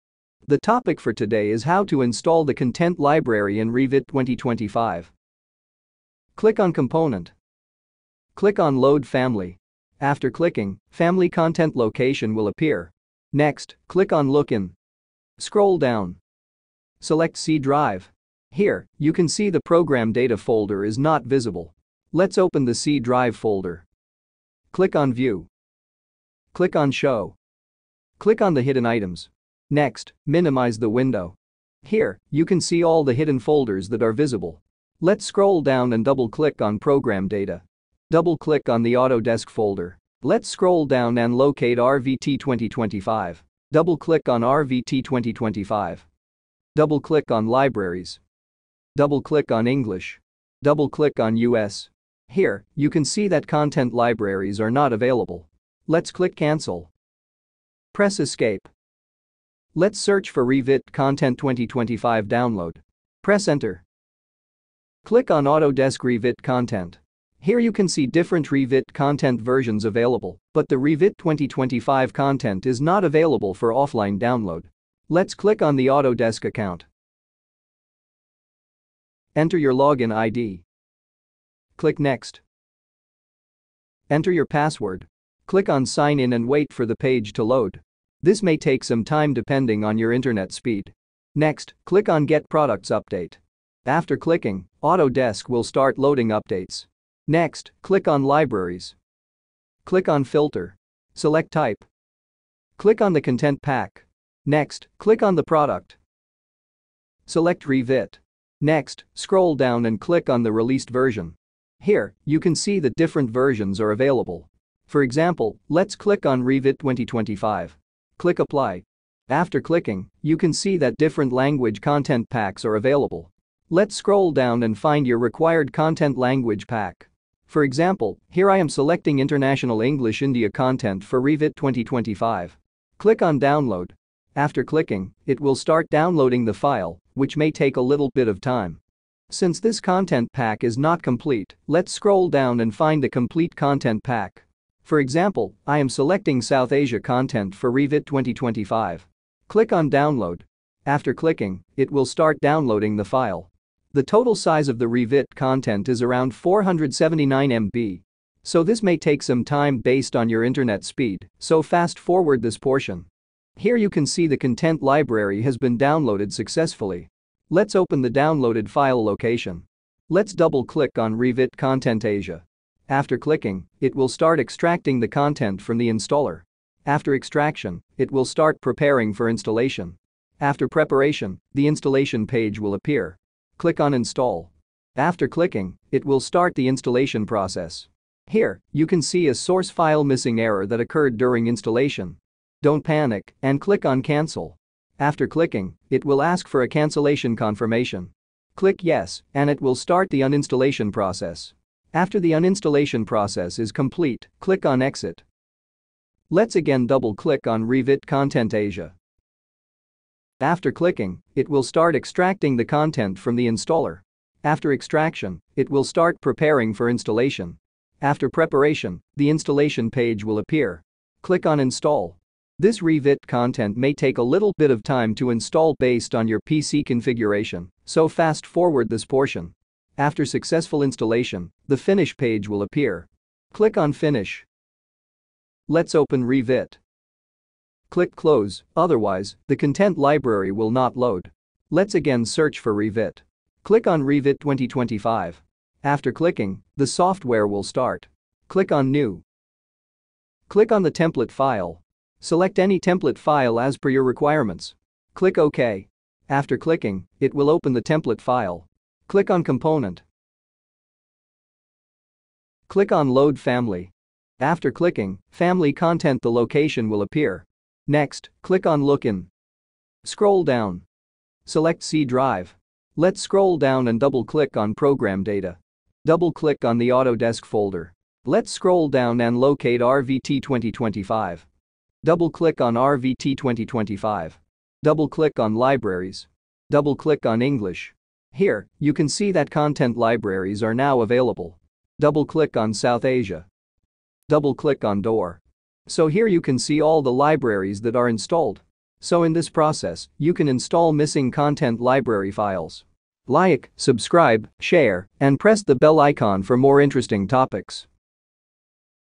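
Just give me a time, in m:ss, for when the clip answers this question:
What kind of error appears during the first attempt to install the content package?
3:09.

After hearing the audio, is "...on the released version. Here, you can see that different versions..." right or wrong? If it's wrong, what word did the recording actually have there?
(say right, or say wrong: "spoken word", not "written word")
right.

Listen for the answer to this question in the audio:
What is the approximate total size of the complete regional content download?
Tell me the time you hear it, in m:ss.
2:36.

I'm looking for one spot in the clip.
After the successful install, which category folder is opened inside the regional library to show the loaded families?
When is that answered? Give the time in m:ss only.
4:55.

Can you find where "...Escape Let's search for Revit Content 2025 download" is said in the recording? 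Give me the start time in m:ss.
0:58.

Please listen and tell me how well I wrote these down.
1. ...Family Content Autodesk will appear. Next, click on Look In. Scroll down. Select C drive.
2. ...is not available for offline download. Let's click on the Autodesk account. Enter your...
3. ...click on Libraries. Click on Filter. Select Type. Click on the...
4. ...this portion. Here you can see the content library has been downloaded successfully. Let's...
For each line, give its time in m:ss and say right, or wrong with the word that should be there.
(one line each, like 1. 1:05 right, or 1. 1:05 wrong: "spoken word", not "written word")
1. 0:10 wrong: "Location", not "Autodesk"
2. 1:12 right
3. 1:37 right
4. 2:42 right.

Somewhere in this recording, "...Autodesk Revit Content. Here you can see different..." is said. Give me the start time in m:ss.
1:05.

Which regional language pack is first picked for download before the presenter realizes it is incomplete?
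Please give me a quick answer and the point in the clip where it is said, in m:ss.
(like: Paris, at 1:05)
International English India, at 2:09.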